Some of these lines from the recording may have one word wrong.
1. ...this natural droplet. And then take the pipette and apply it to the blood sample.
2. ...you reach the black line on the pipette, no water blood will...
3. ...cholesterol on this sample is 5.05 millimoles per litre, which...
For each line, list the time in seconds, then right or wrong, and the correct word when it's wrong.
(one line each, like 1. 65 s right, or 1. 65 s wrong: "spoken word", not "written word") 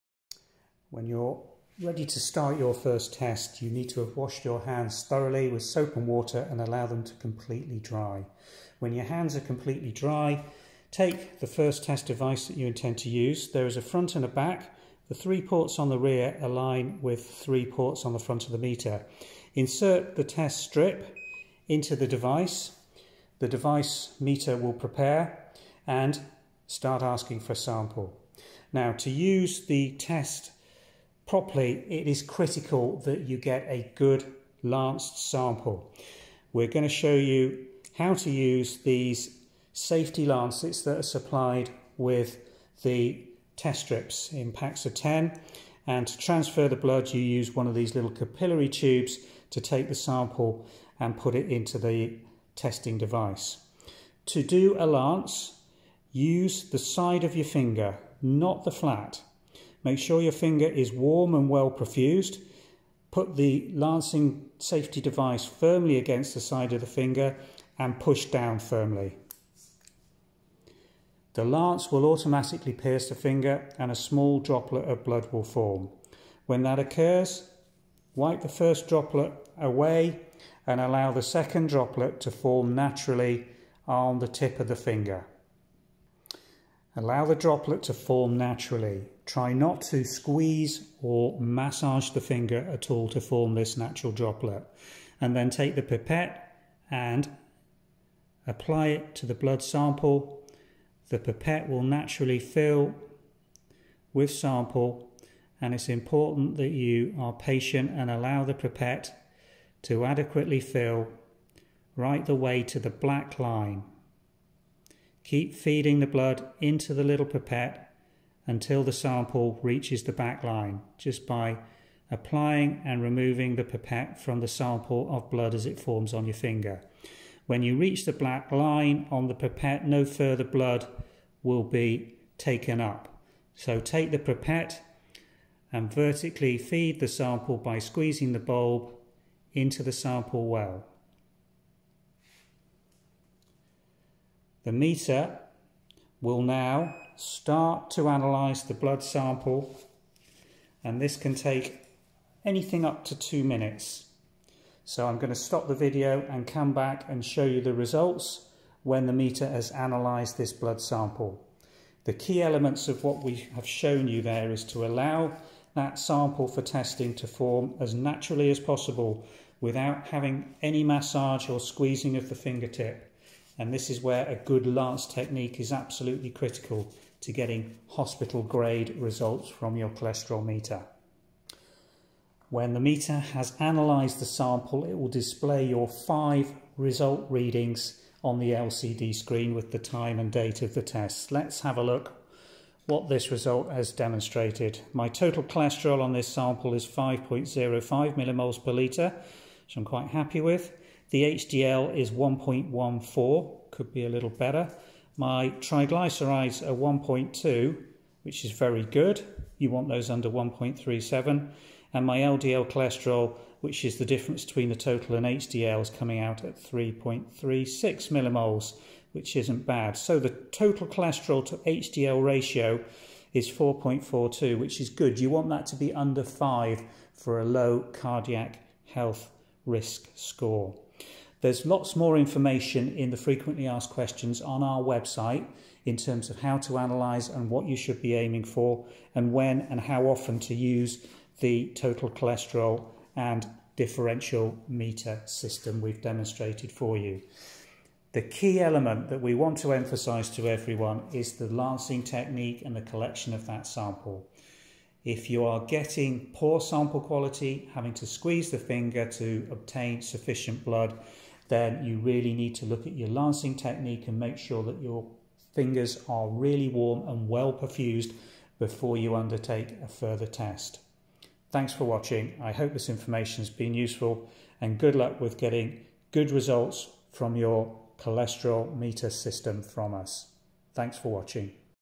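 1. 93 s right
2. 127 s wrong: "further", not "water"
3. 195 s right.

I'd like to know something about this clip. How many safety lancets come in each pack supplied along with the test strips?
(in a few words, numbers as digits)
10.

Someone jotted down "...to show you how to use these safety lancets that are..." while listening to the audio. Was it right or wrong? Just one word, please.
right.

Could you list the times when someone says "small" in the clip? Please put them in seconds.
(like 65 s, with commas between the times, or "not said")
73 s.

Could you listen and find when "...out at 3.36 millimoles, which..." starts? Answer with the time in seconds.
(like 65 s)
216 s.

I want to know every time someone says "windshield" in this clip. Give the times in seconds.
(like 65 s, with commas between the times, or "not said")
not said.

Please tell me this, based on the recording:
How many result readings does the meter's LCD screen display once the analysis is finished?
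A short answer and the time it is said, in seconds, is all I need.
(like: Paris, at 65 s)
5, at 185 s.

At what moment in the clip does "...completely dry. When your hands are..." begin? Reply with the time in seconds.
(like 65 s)
7 s.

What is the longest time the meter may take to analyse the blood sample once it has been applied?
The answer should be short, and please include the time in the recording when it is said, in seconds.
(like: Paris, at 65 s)
2 minutes, at 153 s.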